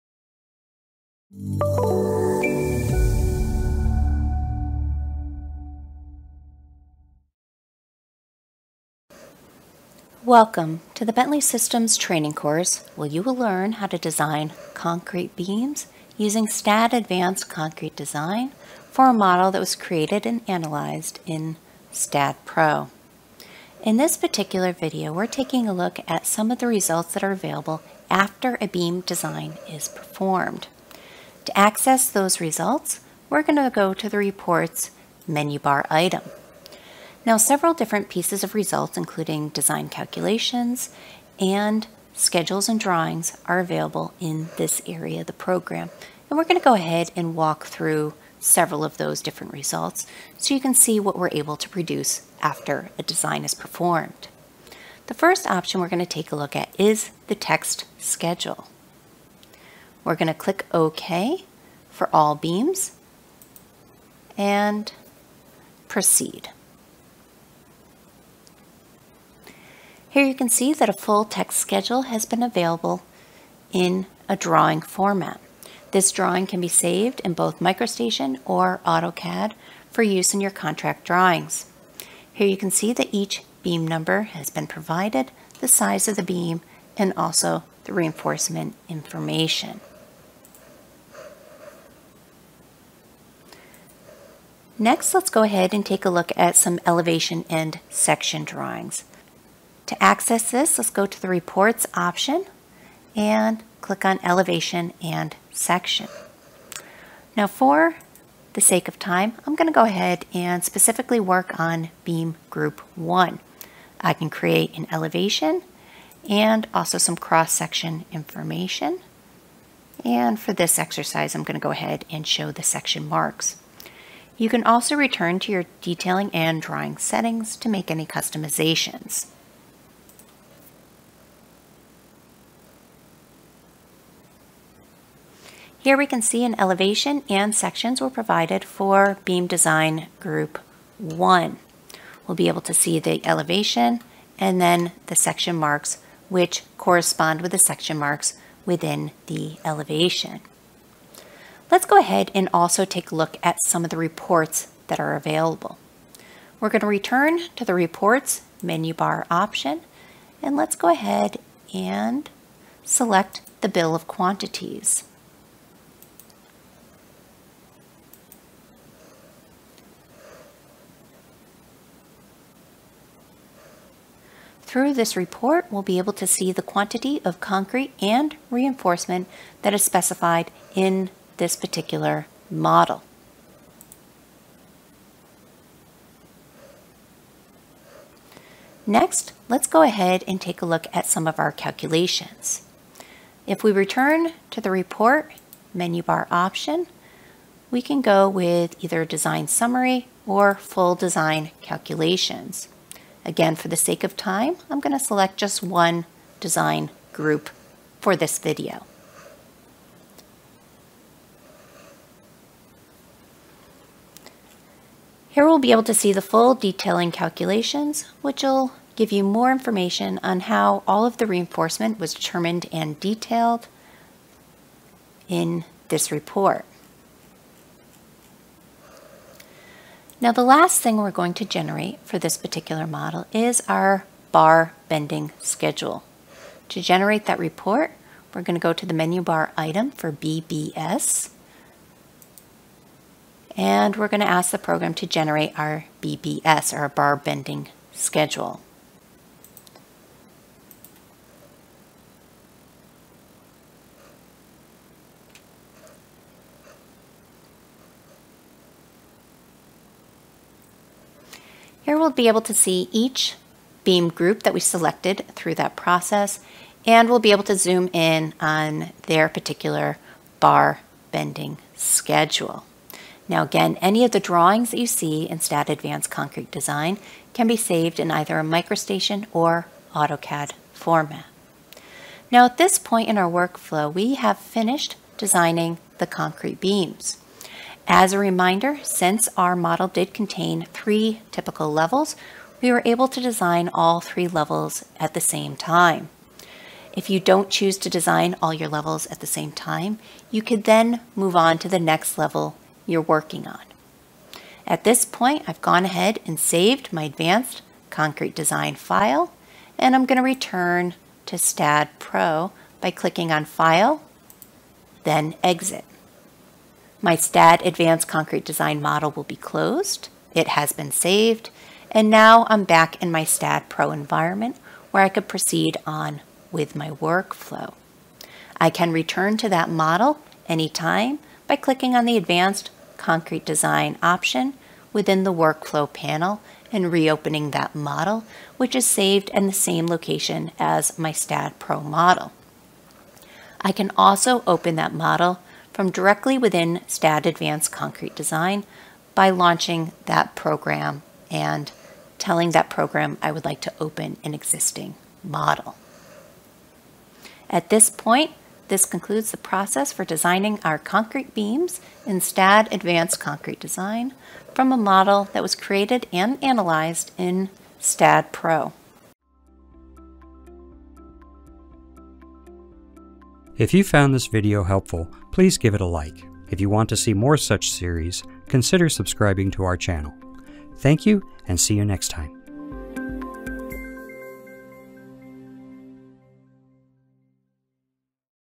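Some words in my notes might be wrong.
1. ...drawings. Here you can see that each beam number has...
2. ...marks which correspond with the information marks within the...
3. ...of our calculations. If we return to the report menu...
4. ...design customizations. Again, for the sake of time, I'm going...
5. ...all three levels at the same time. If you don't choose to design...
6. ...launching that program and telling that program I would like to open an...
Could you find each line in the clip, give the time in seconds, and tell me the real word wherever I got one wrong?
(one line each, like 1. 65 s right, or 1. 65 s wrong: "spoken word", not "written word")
1. 81 s right
2. 145 s wrong: "section", not "information"
3. 191 s right
4. 200 s wrong: "calculations", not "customizations"
5. 293 s right
6. 349 s right.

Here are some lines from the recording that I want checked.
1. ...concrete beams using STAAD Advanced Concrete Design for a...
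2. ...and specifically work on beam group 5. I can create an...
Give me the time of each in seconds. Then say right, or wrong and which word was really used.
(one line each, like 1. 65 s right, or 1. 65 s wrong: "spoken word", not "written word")
1. 14 s right
2. 110 s wrong: "1", not "5".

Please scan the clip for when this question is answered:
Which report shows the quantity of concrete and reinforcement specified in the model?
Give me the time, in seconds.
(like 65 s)
163 s.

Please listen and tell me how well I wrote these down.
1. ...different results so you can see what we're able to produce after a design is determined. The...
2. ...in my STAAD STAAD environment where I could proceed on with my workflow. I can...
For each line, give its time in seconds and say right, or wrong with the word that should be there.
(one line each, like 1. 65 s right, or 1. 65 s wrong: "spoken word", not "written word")
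1. 49 s wrong: "performed", not "determined"
2. 323 s wrong: "Pro", not "STAAD".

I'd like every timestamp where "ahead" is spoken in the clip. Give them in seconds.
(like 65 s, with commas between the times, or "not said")
46 s, 95 s, 109 s, 121 s, 151 s, 160 s, 189 s, 305 s.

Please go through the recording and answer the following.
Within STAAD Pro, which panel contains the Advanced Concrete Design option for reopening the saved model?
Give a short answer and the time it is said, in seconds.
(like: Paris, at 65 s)
Workflow panel, at 335 s.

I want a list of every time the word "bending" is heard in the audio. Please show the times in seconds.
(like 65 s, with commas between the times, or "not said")
234 s, 247 s, 271 s.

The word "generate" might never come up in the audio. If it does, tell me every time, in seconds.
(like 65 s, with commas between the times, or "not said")
231 s, 236 s, 245 s.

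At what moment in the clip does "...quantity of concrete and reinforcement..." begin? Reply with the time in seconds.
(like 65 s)
176 s.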